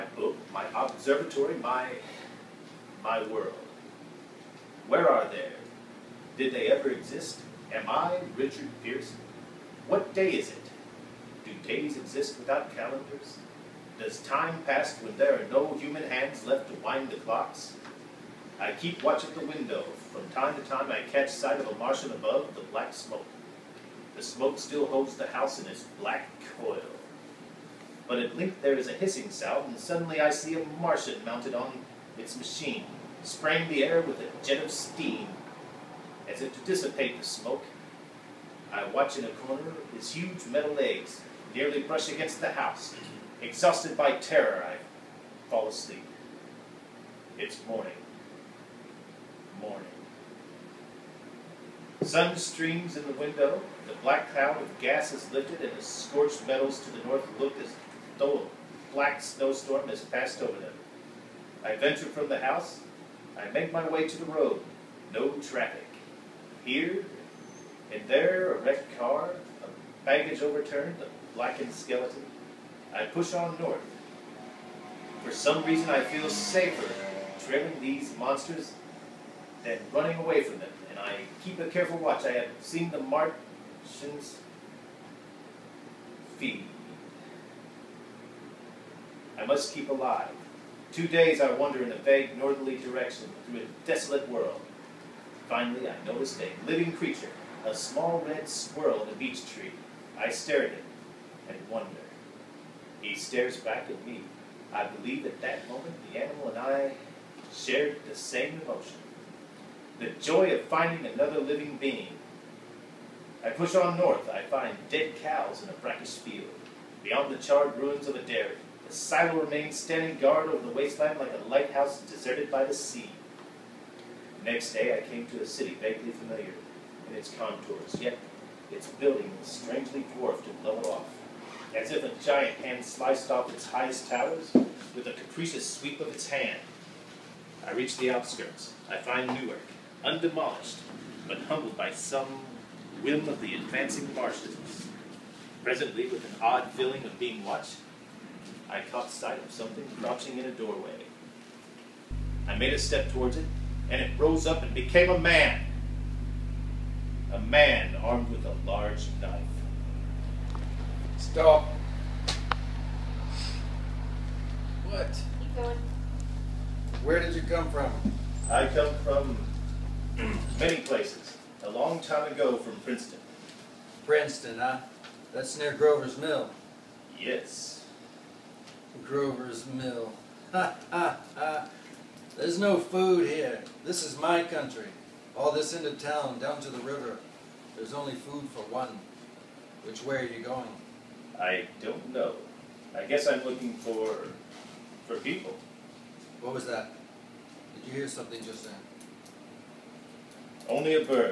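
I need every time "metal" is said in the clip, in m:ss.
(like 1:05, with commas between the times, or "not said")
0:40, 0:56.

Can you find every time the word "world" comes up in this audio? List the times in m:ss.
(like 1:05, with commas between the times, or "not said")
0:03, 1:34.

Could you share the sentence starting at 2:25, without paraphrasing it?
Presently, with an odd feeling of being watched, I caught sight of something crouching in a doorway.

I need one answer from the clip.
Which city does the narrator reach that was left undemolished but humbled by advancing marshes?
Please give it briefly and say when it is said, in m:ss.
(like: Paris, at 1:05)
Newark, at 2:19.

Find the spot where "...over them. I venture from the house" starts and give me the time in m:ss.
1:00.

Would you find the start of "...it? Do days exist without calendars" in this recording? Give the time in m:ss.
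0:10.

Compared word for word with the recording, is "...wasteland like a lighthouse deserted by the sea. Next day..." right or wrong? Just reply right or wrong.
right.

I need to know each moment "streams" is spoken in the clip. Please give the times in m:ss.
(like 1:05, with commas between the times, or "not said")
0:52.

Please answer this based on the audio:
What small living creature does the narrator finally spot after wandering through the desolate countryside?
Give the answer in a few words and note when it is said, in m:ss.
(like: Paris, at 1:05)
red squirrel, at 1:38.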